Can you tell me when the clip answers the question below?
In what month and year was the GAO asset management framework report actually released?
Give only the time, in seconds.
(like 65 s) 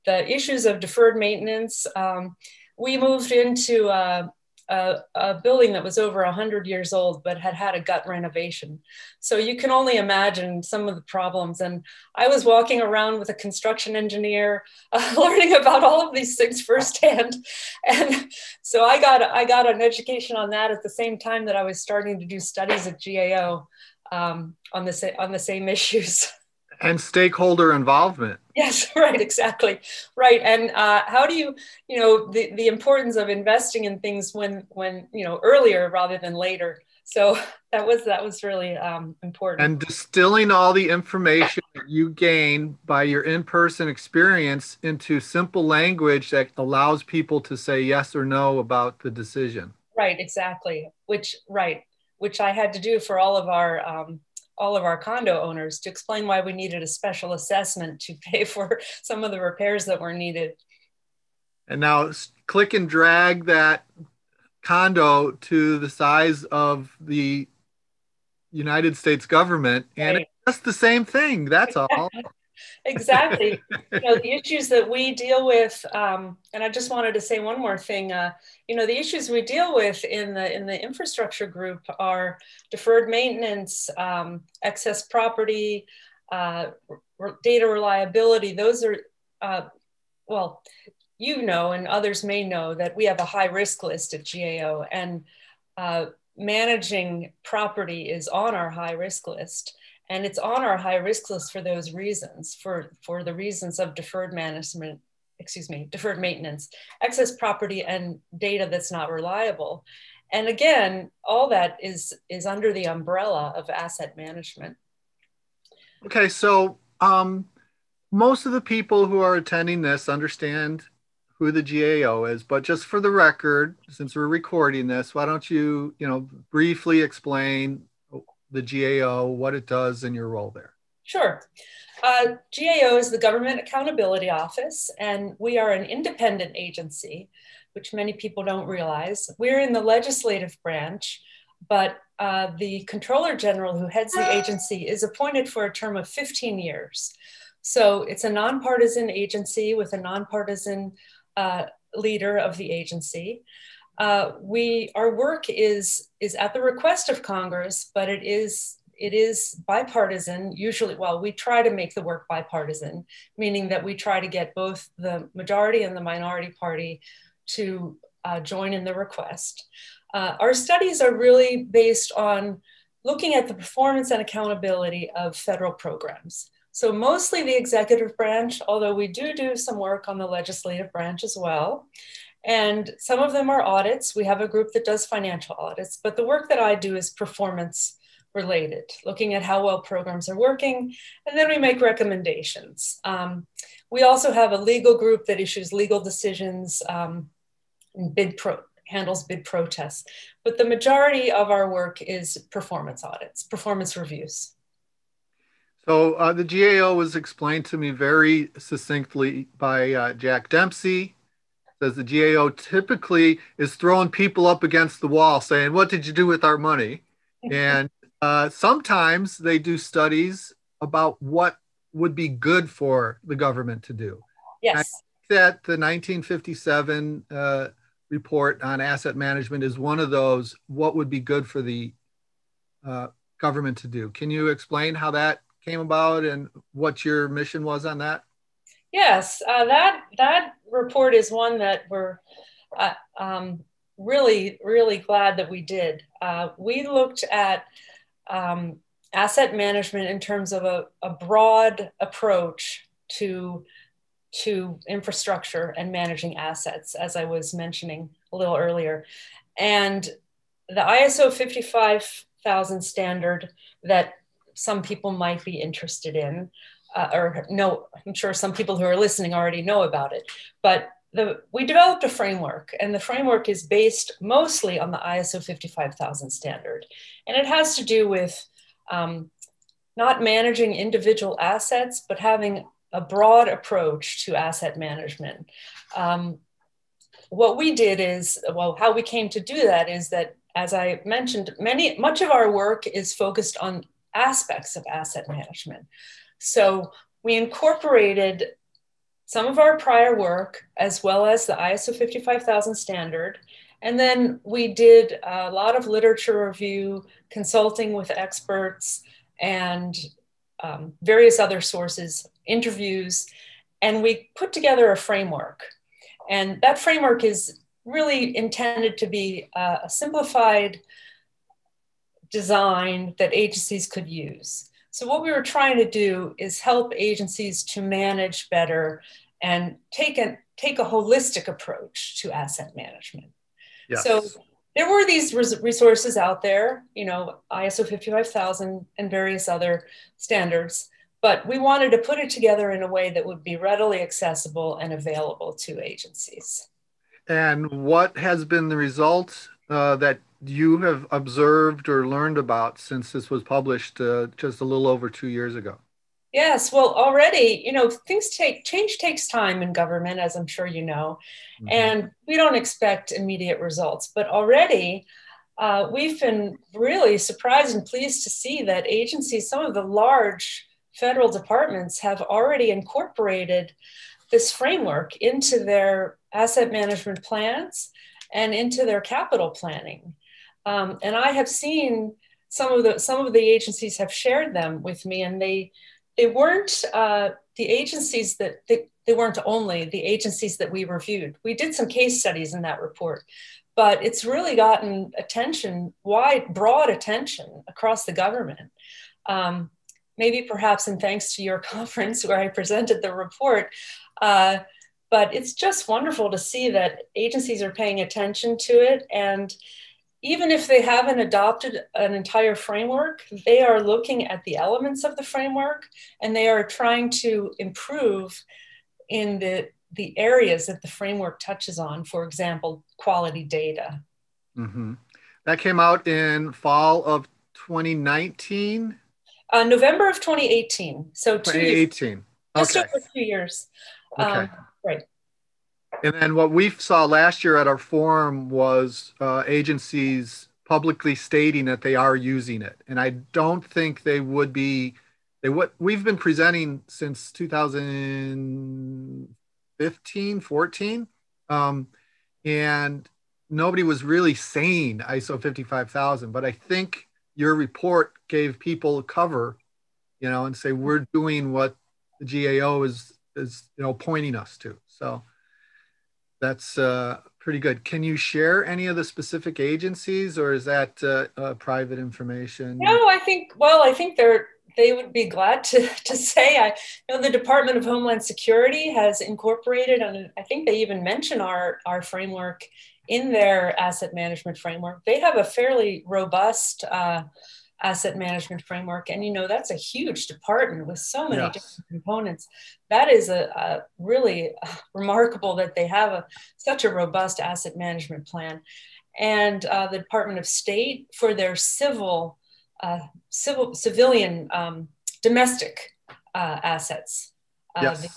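429 s.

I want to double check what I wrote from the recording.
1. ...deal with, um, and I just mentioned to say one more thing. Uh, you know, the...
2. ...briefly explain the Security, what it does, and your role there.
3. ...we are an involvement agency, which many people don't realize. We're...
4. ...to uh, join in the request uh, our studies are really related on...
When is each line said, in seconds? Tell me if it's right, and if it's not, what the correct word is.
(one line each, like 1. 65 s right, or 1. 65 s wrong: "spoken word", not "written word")
1. 75 s wrong: "wanted", not "mentioned"
2. 126 s wrong: "GAO", not "Security"
3. 135 s wrong: "independent", not "involvement"
4. 167 s wrong: "based", not "related".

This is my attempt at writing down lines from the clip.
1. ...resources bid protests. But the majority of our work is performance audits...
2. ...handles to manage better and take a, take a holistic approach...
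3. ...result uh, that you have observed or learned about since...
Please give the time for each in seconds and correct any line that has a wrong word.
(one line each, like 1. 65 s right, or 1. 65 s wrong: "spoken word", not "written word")
1. 198 s wrong: "handles", not "resources"
2. 326 s wrong: "agencies", not "handles"
3. 348 s right.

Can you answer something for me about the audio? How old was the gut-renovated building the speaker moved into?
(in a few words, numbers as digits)
over 100 years.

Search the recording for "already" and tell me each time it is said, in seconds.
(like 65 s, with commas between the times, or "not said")
269 s, 356 s, 364 s, 372 s.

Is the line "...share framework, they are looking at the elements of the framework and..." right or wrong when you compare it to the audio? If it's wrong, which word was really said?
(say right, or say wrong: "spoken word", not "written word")
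wrong: "entire", not "share".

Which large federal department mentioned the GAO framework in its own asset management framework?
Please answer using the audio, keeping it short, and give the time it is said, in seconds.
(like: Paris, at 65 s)
Department of Homeland Security, at 477 s.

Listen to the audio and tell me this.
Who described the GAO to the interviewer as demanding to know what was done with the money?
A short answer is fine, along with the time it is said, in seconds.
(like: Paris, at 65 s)
Jack Dempsey, at 210 s.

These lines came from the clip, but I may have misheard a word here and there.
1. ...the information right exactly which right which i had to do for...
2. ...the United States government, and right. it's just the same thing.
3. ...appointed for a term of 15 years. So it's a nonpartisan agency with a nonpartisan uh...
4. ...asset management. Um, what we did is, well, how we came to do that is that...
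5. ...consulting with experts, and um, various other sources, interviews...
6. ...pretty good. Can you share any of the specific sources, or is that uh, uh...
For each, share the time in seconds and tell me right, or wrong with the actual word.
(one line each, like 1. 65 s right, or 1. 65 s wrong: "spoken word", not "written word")
1. 48 s wrong: "decision", not "information"
2. 66 s right
3. 145 s right
4. 284 s right
5. 307 s right
6. 467 s wrong: "agencies", not "sources".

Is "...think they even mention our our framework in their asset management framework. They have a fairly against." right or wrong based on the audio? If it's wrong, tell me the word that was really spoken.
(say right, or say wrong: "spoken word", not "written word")
wrong: "robust", not "against".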